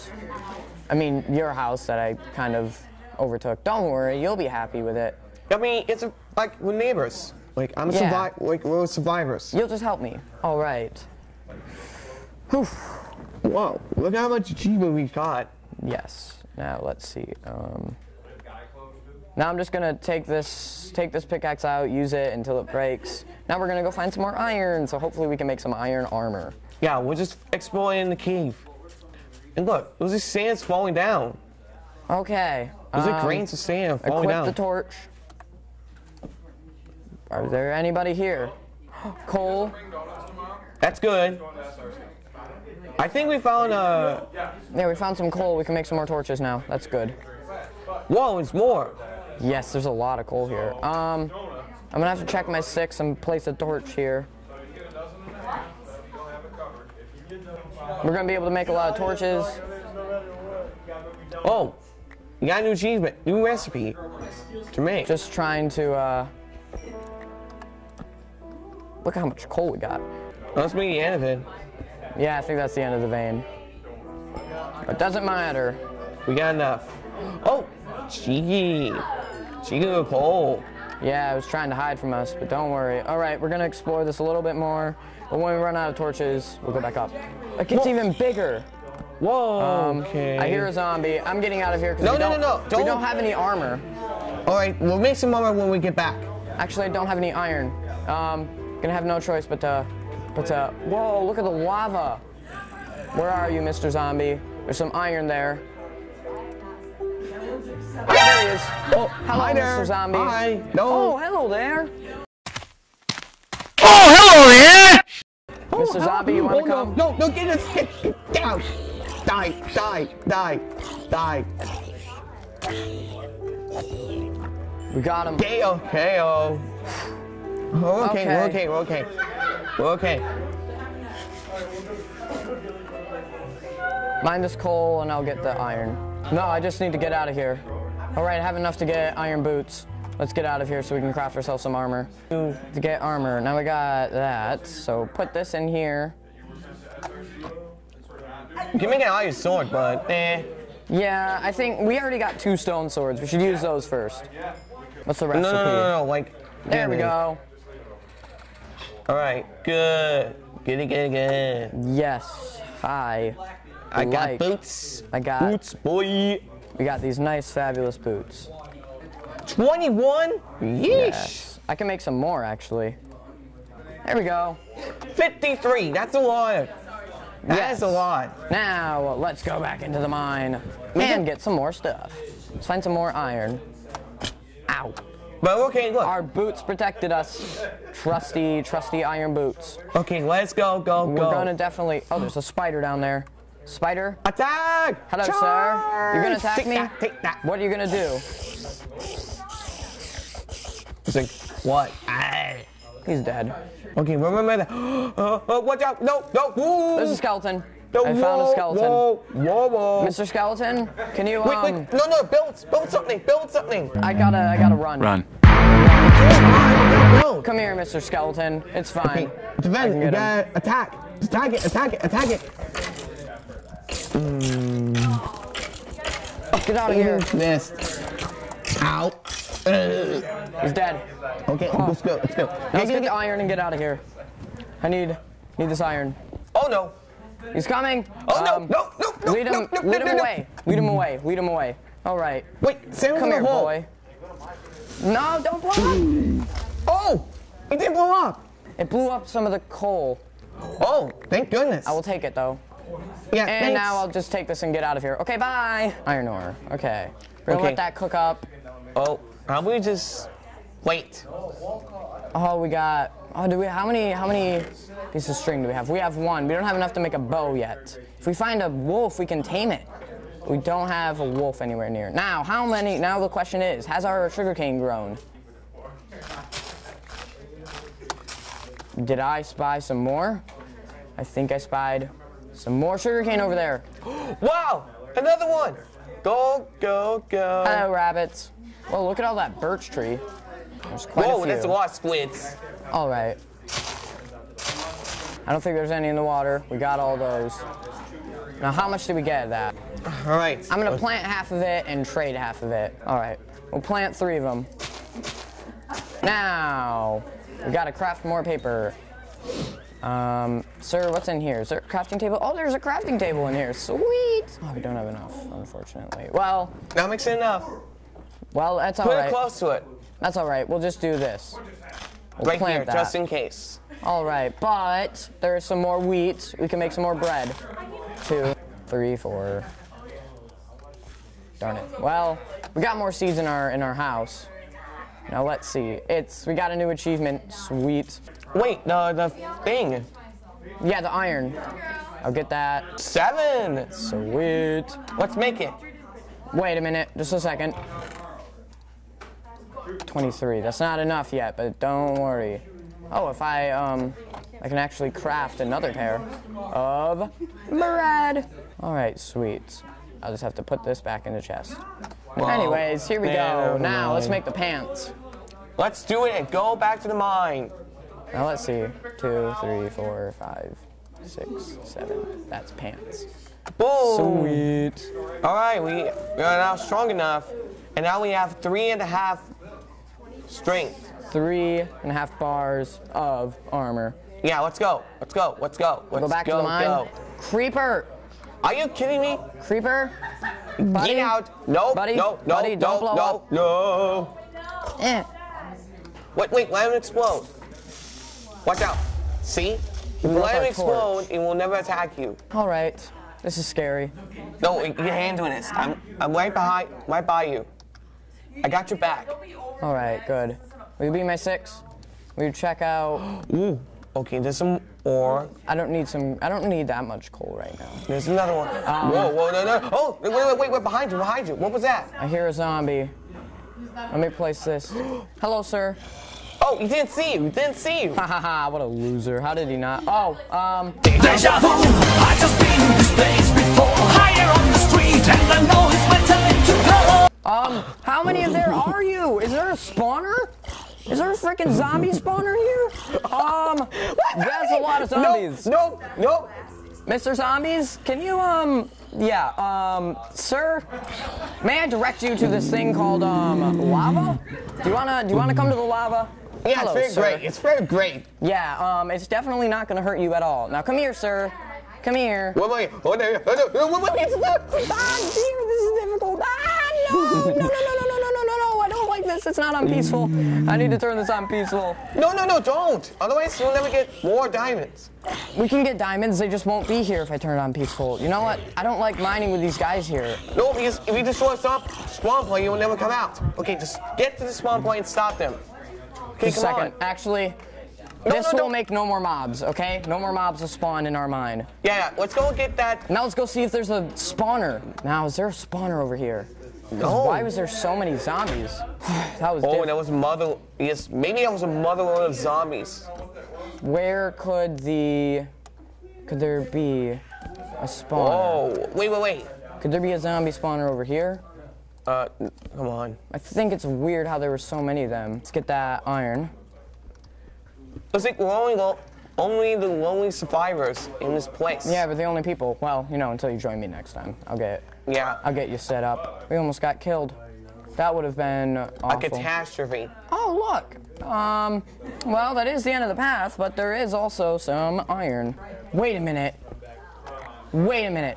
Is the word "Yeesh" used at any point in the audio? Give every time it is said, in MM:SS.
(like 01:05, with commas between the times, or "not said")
02:50.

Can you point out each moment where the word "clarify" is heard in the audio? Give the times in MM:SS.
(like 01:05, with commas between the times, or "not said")
not said.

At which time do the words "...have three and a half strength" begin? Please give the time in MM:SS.
06:18.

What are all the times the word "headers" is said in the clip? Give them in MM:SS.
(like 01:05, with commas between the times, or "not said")
not said.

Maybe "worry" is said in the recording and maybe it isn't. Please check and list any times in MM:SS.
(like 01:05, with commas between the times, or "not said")
00:03, 01:22, 05:52.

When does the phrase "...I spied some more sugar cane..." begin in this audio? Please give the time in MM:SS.
04:41.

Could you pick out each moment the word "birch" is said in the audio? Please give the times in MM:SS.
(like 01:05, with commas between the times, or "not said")
04:49.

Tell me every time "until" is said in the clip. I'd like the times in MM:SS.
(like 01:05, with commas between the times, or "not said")
00:22, 08:43.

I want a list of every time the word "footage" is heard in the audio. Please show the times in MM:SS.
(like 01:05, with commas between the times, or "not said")
not said.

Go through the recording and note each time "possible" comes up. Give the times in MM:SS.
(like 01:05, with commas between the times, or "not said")
not said.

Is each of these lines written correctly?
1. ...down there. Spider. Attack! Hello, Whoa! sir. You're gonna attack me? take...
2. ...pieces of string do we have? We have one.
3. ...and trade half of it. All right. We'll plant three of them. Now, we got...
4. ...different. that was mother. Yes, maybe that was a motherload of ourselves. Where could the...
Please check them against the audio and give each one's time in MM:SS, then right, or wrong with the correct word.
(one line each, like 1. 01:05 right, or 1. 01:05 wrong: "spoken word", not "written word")
1. 03:12 wrong: "Charge", not "Whoa"
2. 04:25 right
3. 05:01 right
4. 08:19 wrong: "zombies", not "ourselves".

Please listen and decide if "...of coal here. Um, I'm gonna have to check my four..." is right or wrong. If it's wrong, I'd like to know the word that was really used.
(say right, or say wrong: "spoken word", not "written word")
wrong: "six", not "four".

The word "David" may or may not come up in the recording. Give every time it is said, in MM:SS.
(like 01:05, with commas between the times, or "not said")
not said.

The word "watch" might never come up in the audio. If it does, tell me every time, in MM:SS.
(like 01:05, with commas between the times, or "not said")
03:25, 06:38.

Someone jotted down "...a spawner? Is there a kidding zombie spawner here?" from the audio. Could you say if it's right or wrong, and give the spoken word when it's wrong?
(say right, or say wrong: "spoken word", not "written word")
wrong: "freaking", not "kidding".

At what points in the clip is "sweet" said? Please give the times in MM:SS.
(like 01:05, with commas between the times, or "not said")
05:13, 05:37, 05:43, 05:59, 06:14.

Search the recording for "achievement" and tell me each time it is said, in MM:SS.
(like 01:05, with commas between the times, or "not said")
00:14, 01:02, 05:36.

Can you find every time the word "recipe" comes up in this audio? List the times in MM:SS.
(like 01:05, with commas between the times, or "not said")
01:03, 02:35.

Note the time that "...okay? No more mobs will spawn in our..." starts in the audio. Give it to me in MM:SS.
08:09.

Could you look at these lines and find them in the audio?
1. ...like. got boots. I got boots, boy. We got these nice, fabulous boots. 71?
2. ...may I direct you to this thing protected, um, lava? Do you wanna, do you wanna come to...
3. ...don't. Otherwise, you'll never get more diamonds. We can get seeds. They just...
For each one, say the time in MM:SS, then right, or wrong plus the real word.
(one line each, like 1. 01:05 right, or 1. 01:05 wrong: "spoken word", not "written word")
1. 02:44 wrong: "21", not "71"
2. 07:31 wrong: "called", not "protected"
3. 07:52 wrong: "diamonds", not "seeds".